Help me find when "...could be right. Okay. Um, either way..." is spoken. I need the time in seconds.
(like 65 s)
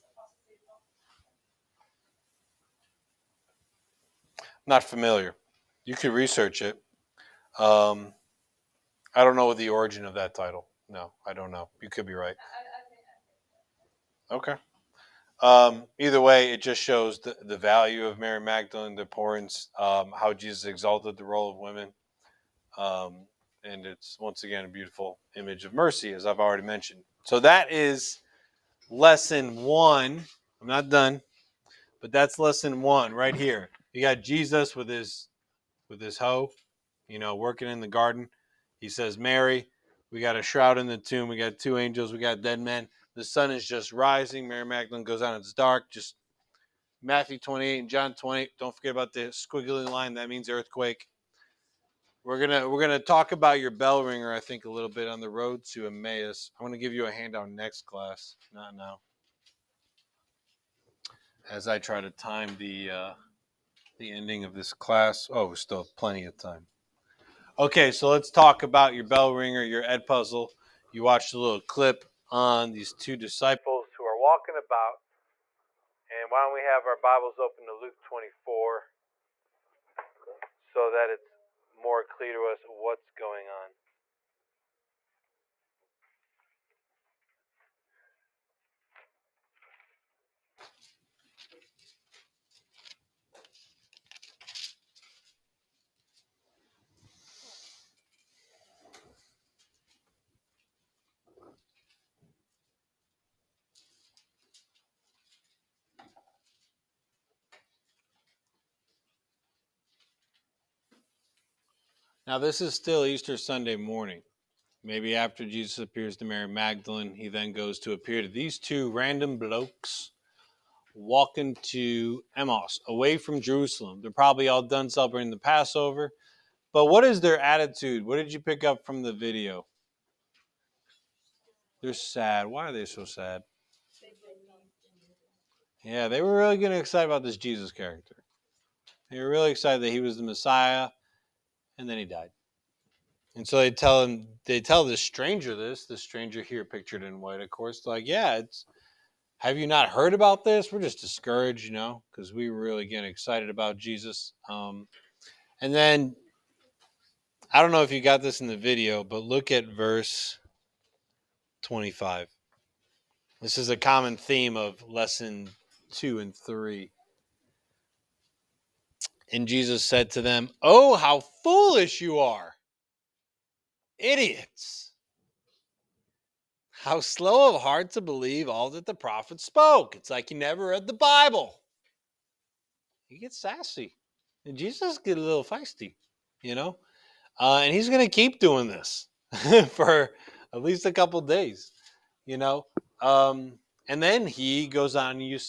11 s.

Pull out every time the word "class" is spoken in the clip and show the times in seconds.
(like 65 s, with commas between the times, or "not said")
57 s, 64 s.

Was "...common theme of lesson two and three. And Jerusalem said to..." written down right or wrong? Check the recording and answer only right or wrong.
wrong.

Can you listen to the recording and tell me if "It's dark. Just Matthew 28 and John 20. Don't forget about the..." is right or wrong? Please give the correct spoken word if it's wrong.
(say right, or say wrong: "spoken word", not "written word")
right.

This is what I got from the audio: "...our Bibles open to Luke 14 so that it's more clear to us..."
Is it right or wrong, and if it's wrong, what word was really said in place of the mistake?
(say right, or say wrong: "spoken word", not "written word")
wrong: "24", not "14".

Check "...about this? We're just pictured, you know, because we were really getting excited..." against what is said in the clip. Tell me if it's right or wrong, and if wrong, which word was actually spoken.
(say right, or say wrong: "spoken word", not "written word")
wrong: "discouraged", not "pictured".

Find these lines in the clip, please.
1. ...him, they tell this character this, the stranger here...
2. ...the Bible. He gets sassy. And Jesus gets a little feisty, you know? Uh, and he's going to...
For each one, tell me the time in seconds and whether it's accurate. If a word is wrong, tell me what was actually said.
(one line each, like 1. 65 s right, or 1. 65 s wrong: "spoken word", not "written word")
1. 144 s wrong: "stranger", not "character"
2. 180 s right.